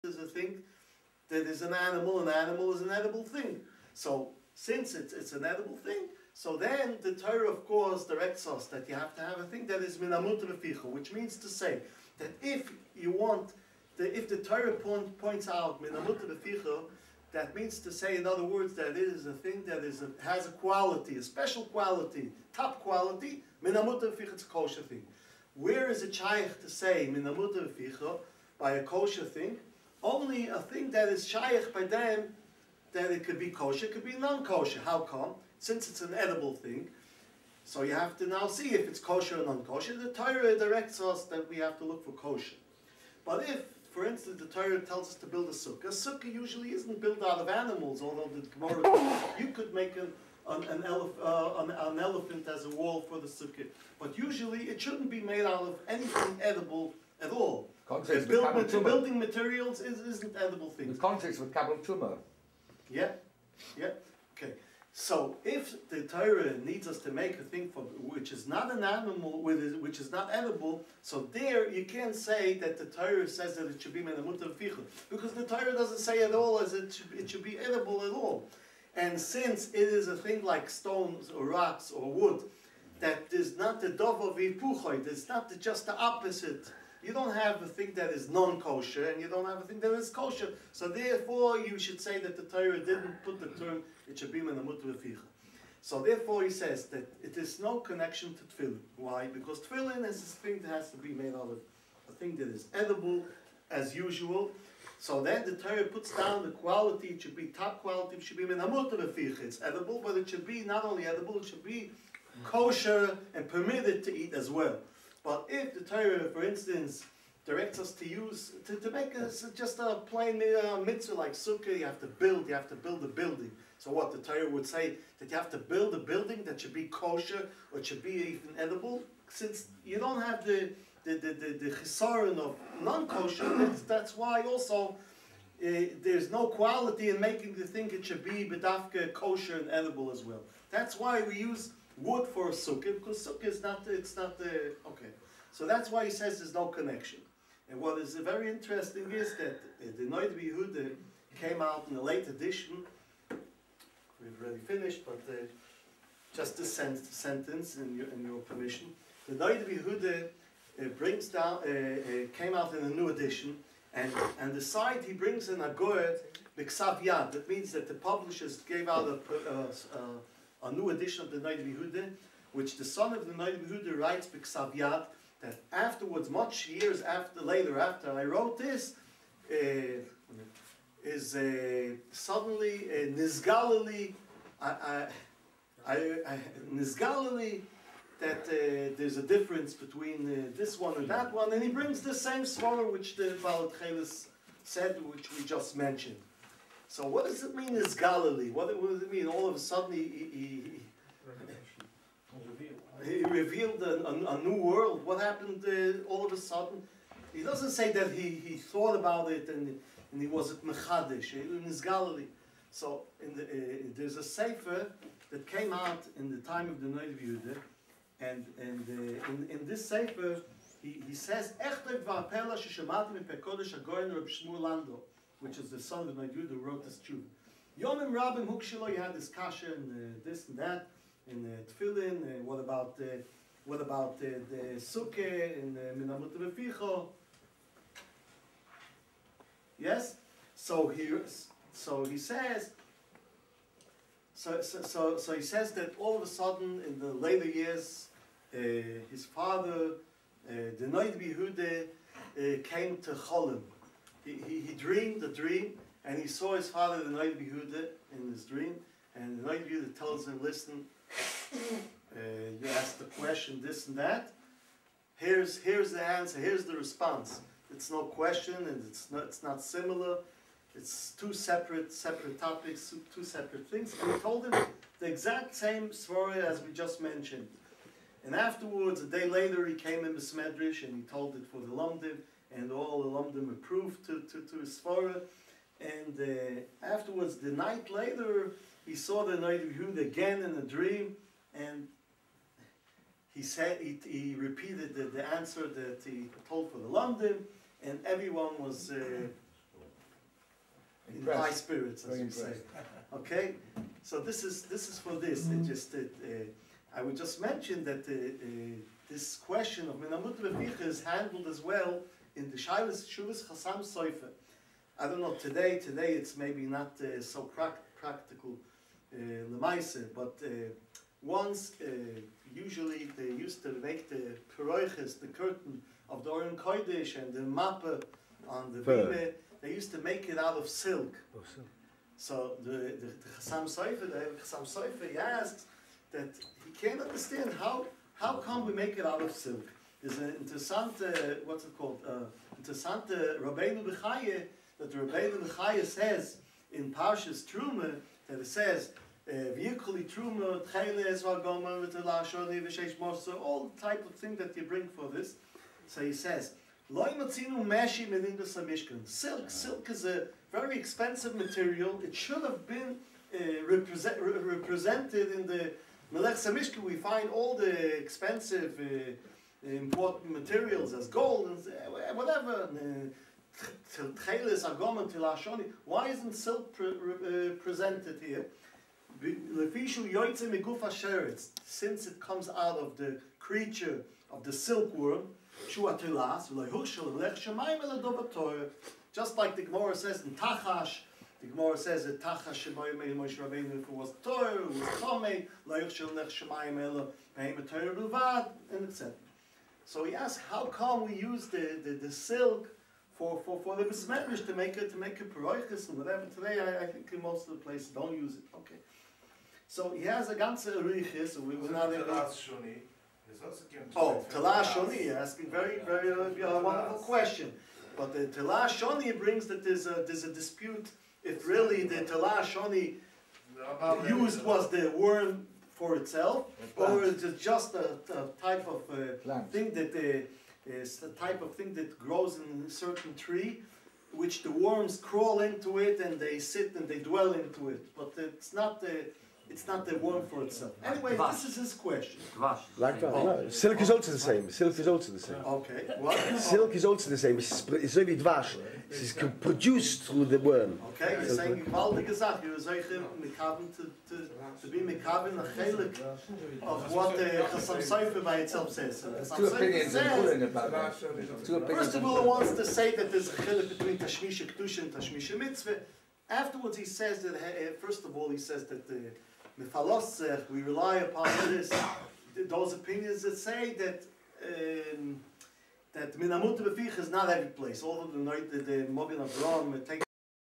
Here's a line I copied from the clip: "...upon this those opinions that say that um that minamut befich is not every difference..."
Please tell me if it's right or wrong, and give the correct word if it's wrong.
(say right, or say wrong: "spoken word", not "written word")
wrong: "place", not "difference".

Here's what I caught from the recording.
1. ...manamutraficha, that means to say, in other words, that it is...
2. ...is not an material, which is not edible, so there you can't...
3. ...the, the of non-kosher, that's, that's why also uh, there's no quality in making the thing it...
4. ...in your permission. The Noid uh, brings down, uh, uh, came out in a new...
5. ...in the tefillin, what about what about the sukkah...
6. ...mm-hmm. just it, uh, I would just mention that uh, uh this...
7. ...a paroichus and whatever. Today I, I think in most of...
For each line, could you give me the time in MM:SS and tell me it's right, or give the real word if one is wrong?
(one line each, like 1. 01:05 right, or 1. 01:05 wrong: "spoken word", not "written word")
1. 00:16 wrong: "reficha", not "manamutraficha"
2. 01:08 wrong: "animal", not "material"
3. 02:11 right
4. 02:38 right
5. 03:51 right
6. 05:05 right
7. 06:45 right.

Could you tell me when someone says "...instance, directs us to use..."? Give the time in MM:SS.
01:56.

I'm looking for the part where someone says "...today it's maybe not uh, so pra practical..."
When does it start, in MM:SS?
05:15.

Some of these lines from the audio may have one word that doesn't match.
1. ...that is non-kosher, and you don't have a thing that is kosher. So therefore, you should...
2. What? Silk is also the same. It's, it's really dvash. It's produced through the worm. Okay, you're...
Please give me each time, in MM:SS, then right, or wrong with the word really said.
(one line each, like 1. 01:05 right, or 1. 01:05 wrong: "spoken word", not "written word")
1. 01:27 right
2. 07:25 right.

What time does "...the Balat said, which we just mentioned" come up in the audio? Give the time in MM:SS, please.
03:13.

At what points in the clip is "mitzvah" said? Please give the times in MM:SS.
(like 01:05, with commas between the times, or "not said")
02:00, 07:45.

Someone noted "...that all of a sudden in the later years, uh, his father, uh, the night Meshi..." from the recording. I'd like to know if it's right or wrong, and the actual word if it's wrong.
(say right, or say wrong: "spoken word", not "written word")
wrong: "Bihude", not "Meshi".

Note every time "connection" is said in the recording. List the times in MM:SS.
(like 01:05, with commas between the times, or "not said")
01:37, 02:26.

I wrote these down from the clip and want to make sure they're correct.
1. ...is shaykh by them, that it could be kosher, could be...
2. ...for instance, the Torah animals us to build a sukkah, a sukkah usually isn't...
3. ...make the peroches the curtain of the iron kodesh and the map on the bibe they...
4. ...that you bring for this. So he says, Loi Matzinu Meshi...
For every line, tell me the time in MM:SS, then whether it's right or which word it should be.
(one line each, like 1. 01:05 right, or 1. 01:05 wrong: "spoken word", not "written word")
1. 00:31 right
2. 00:43 wrong: "tells", not "animals"
3. 05:23 right
4. 05:54 right.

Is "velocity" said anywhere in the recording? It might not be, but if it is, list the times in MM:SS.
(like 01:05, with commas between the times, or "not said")
not said.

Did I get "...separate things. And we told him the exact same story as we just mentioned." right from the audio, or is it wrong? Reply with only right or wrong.
right.